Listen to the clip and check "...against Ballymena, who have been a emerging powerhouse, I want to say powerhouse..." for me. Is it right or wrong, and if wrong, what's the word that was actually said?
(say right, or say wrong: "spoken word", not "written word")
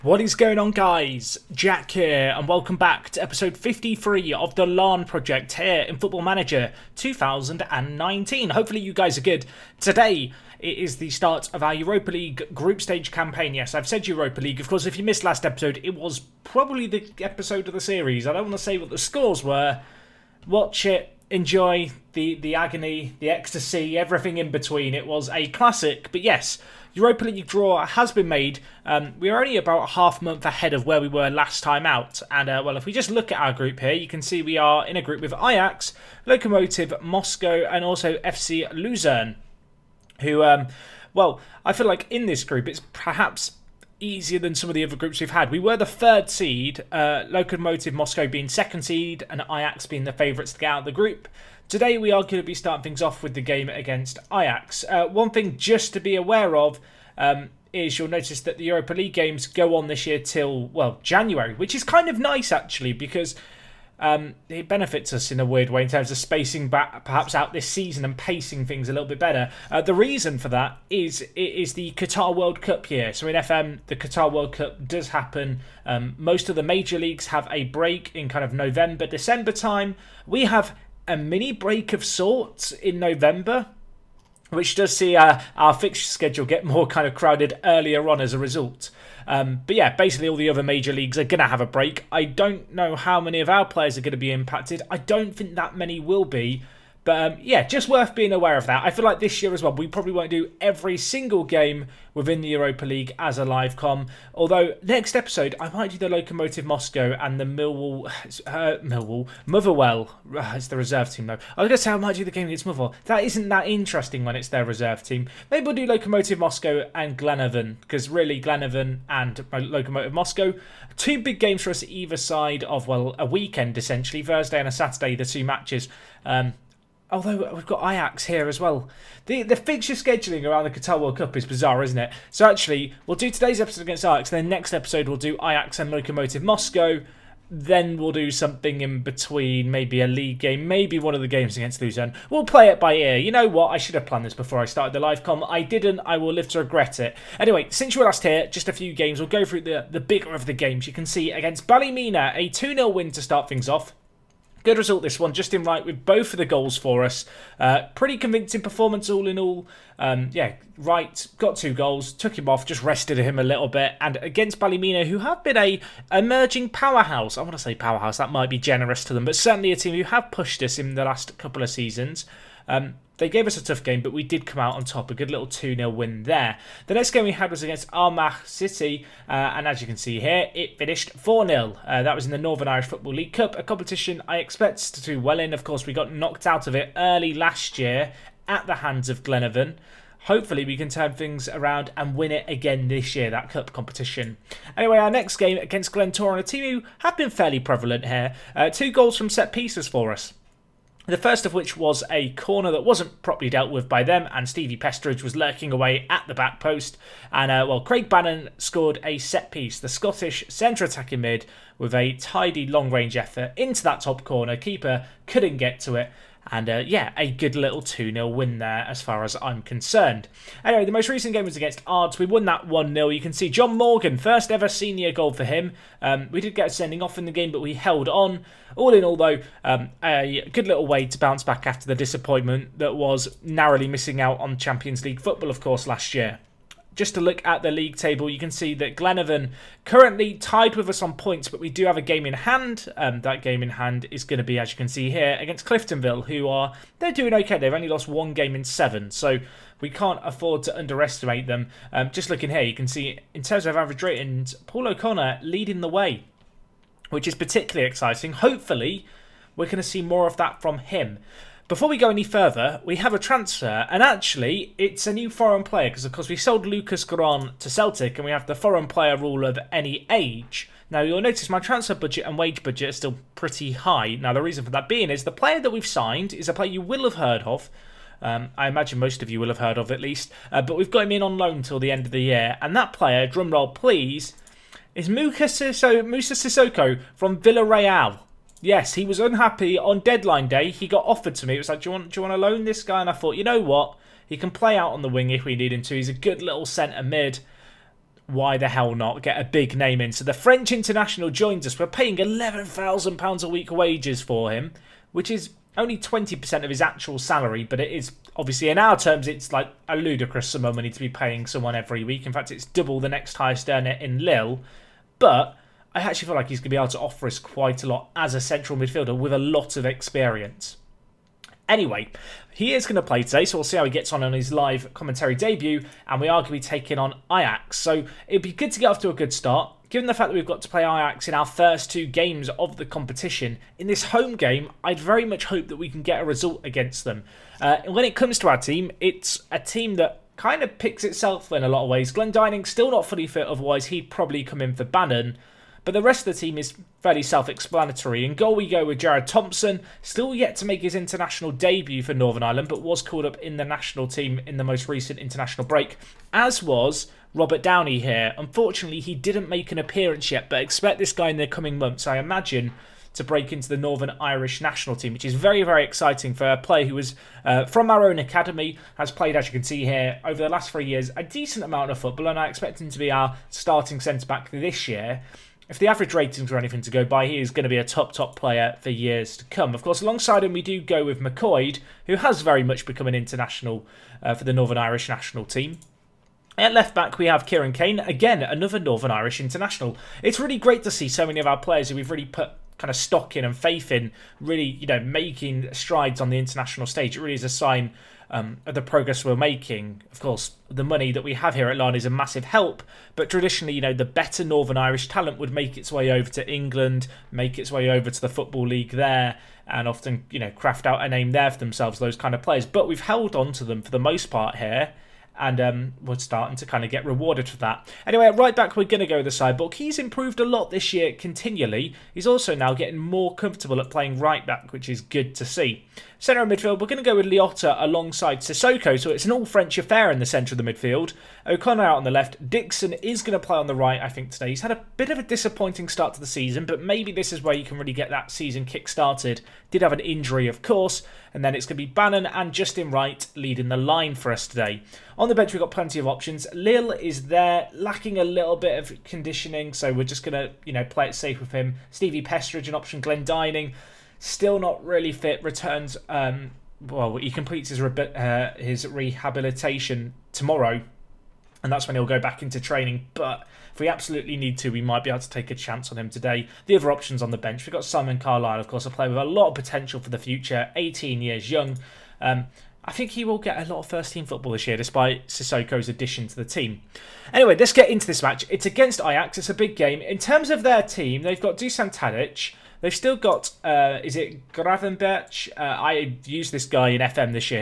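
right.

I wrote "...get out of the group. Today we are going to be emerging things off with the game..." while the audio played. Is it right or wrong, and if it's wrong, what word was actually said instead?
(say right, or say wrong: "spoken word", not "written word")
wrong: "starting", not "emerging".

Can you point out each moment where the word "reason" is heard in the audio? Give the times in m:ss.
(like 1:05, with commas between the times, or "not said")
1:09, 4:34.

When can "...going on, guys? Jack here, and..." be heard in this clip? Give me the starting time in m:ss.
0:00.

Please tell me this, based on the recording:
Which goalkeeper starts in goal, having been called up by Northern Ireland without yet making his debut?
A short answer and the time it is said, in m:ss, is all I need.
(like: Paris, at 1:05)
Jared Thompson, at 5:48.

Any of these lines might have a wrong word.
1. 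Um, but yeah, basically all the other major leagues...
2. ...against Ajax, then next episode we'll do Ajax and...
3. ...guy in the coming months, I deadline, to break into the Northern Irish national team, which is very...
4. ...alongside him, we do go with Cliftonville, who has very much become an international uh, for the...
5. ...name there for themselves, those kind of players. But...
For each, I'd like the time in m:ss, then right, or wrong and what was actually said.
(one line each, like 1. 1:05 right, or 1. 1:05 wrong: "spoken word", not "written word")
1. 1:29 right
2. 2:13 right
3. 6:01 wrong: "imagine", not "deadline"
4. 6:19 wrong: "McCoyd", not "Cliftonville"
5. 6:51 right.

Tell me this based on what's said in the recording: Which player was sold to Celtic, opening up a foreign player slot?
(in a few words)
Lucas Goran.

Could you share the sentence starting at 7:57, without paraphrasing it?
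Anyway, let's get into this match.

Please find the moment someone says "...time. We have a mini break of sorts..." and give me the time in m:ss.
1:19.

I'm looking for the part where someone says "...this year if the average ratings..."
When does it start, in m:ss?
6:14.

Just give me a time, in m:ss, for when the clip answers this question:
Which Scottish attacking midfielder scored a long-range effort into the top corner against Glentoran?
3:27.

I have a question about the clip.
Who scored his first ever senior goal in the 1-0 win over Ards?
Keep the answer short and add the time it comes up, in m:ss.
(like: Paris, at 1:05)
John Morgan, at 3:43.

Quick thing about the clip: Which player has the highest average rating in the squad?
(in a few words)
Paul O'Connor.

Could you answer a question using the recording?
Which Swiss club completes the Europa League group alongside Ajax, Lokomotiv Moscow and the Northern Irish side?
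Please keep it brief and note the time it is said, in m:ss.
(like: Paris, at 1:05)
FC Luzern, at 0:38.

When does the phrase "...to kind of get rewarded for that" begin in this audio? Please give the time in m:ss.
6:56.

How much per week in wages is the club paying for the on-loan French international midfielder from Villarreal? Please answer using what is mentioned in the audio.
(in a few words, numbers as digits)
£11,000.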